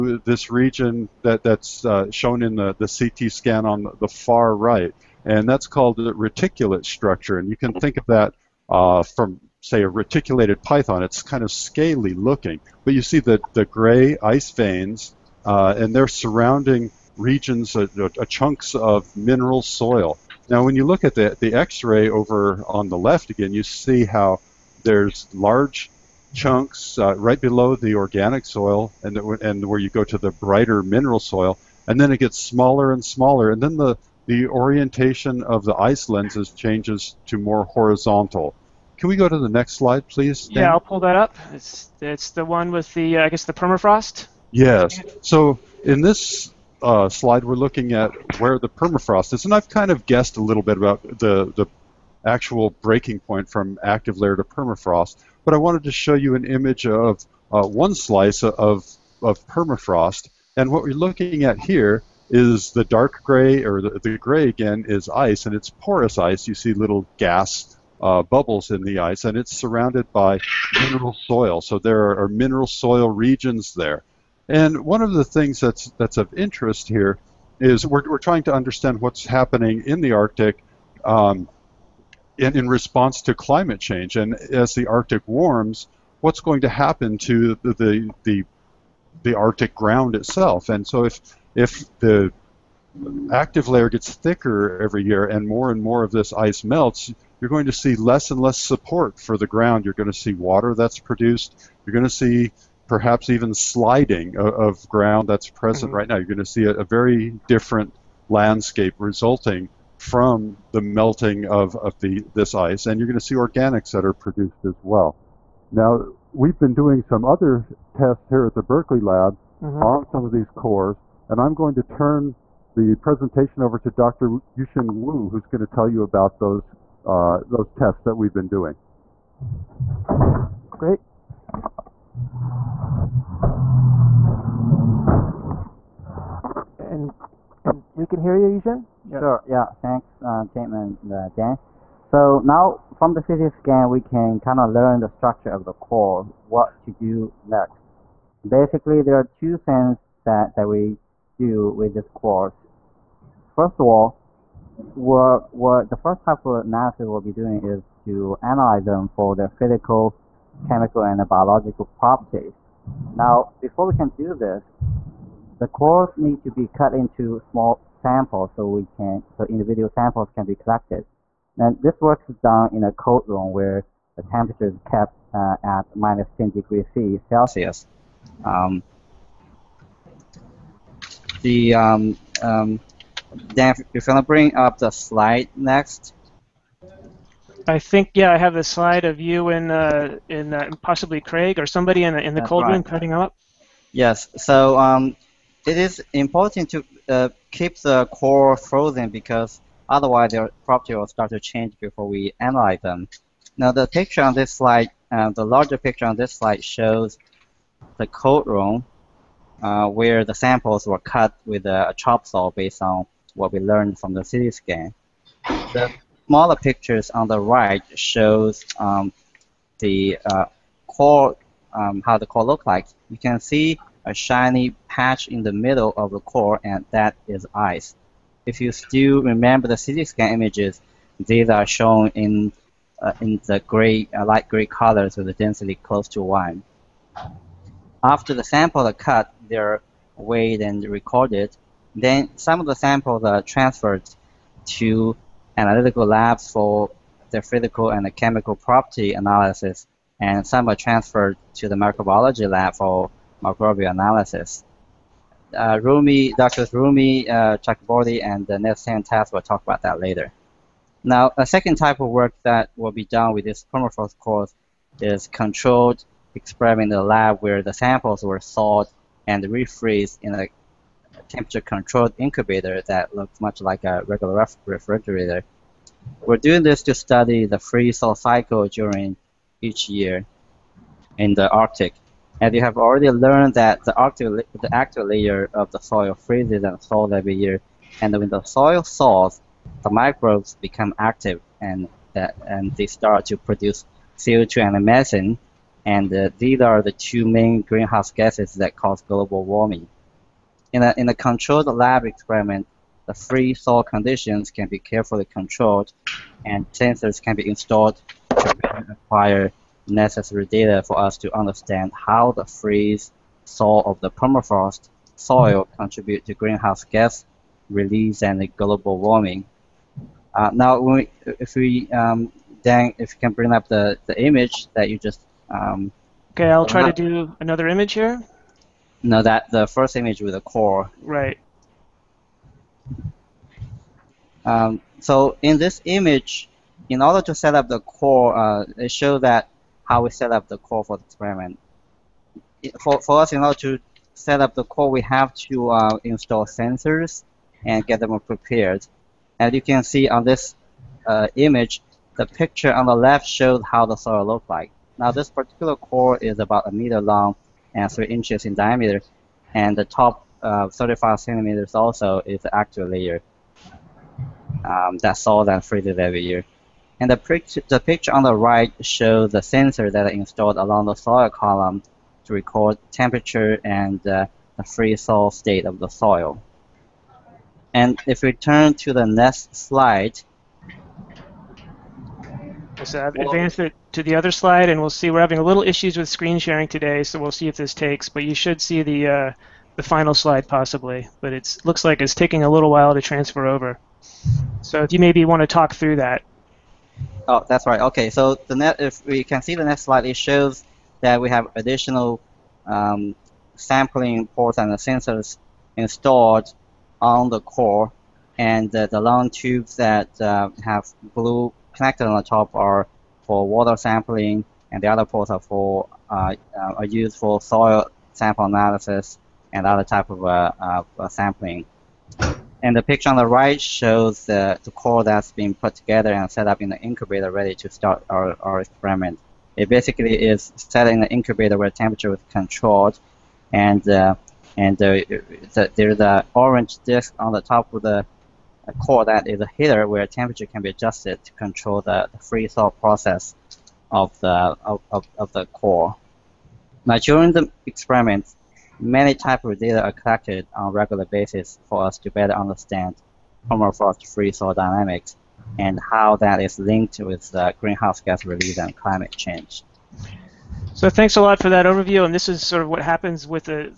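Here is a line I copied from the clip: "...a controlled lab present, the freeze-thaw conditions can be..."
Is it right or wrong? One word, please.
wrong.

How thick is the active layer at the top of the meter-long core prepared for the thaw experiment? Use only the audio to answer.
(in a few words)
35 centimeters.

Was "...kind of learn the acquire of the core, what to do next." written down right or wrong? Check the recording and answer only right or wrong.
wrong.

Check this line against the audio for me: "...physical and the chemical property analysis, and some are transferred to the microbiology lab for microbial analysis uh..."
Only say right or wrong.
right.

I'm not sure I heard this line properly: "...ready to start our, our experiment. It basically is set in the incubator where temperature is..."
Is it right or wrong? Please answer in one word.
right.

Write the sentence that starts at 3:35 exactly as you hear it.
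The smaller pictures on the right shows um, the uh, core, um, how the core looked like.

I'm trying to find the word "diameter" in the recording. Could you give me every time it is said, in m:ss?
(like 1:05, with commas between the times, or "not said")
5:58.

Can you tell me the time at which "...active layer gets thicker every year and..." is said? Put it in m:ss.
1:33.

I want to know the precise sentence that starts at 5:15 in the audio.
contribute to greenhouse gas release and global warming.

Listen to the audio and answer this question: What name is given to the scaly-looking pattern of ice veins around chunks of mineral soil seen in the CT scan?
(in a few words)
reticulate structure.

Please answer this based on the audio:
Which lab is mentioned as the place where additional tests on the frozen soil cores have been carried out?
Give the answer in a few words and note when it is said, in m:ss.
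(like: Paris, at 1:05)
Berkeley lab, at 1:58.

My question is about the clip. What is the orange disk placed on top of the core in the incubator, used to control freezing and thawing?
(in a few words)
a heater.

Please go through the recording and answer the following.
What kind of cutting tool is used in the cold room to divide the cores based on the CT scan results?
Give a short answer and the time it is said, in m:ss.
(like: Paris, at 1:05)
chop saw, at 3:31.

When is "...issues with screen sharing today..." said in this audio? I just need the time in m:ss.
6:25.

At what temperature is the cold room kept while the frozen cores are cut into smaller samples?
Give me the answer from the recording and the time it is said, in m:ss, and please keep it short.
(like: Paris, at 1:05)
-10 degrees Celsius, at 2:55.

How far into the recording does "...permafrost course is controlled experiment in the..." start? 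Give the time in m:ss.
4:23.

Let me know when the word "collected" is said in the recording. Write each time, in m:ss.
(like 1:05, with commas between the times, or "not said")
2:50, 7:29.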